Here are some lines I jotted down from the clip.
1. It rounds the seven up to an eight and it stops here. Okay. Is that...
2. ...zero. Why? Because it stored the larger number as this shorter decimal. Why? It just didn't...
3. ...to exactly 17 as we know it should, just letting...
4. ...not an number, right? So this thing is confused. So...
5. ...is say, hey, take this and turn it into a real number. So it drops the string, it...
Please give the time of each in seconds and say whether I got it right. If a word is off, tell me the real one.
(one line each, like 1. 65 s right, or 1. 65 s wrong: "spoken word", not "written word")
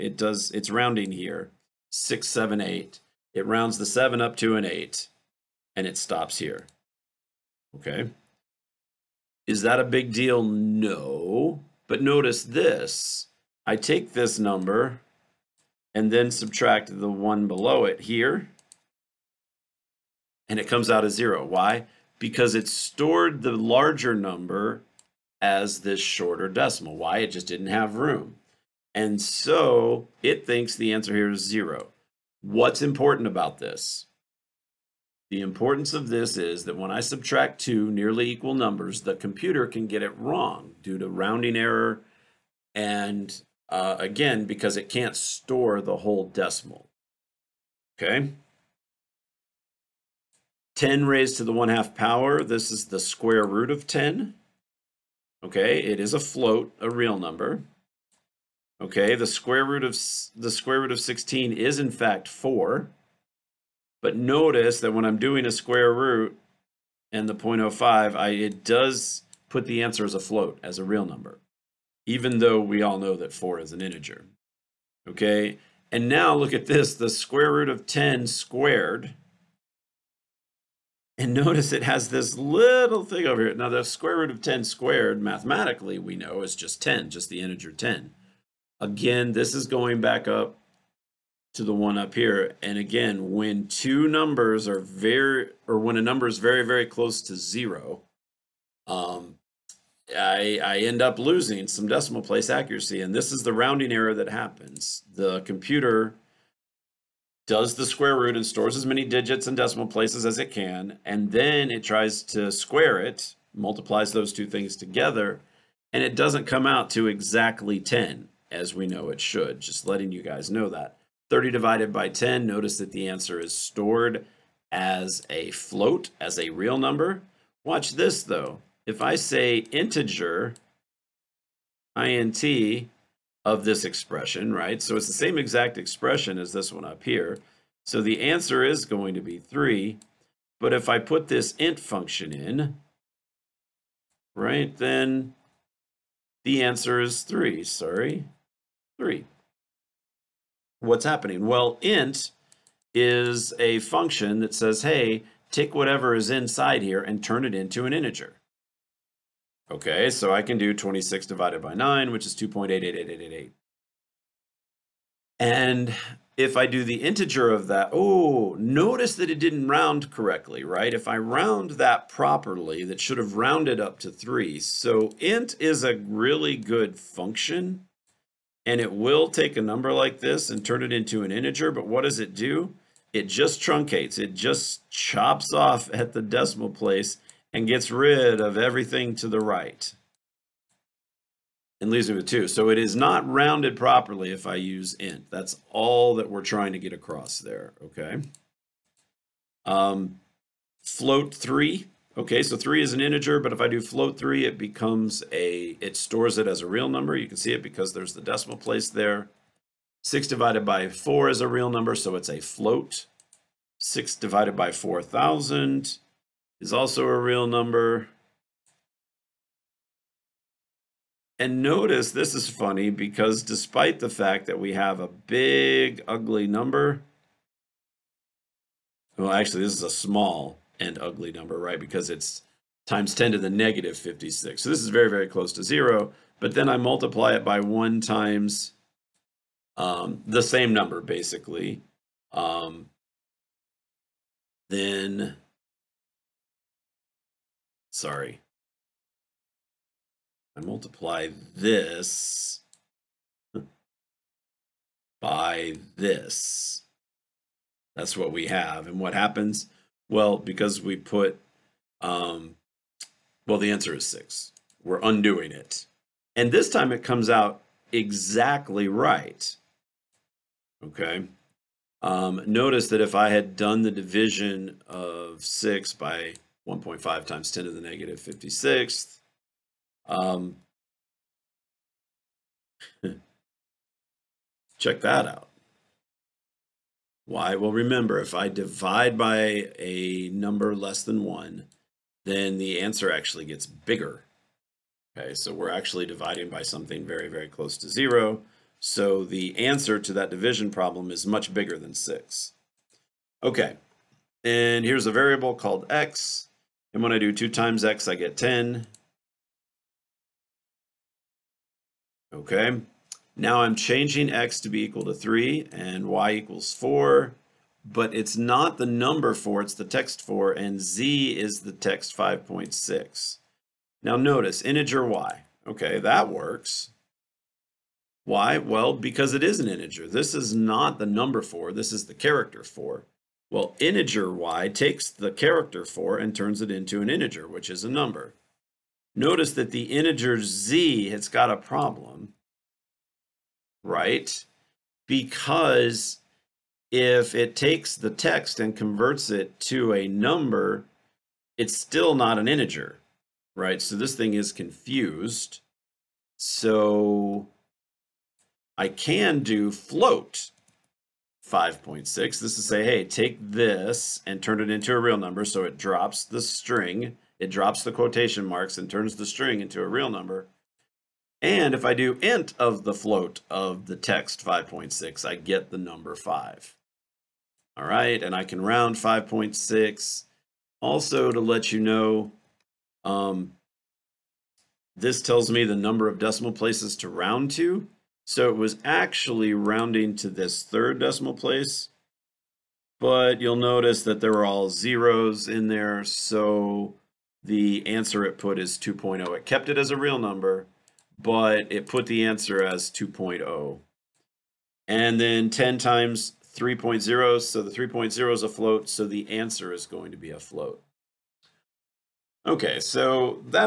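1. 3 s right
2. 21 s right
3. 116 s wrong: "10", not "17"
4. 352 s wrong: "integer", not "number"
5. 362 s right.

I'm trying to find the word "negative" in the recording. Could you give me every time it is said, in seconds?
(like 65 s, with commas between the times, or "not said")
233 s, 277 s.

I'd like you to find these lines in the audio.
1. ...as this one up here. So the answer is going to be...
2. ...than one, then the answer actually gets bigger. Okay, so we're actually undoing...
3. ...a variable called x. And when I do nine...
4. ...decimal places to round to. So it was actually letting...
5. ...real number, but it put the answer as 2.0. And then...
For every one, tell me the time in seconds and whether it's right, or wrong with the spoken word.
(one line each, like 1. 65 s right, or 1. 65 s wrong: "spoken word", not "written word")
1. 136 s right
2. 291 s wrong: "dividing", not "undoing"
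3. 305 s wrong: "two", not "nine"
4. 386 s wrong: "rounding", not "letting"
5. 399 s right.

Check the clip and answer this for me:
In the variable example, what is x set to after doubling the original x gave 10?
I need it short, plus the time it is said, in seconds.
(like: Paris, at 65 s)
3, at 314 s.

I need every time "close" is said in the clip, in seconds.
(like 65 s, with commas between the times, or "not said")
96 s, 235 s, 297 s.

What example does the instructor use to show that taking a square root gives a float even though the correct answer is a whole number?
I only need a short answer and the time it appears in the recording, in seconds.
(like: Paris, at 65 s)
square root of 16, at 60 s.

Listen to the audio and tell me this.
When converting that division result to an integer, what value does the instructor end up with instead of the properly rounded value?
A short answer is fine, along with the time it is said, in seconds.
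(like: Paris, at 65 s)
2, at 191 s.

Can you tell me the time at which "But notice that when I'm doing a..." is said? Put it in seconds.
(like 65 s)
64 s.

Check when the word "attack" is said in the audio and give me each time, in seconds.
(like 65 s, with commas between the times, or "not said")
not said.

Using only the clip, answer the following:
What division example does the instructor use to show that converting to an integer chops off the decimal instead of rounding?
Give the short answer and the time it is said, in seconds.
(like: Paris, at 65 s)
26 divided by 9, at 160 s.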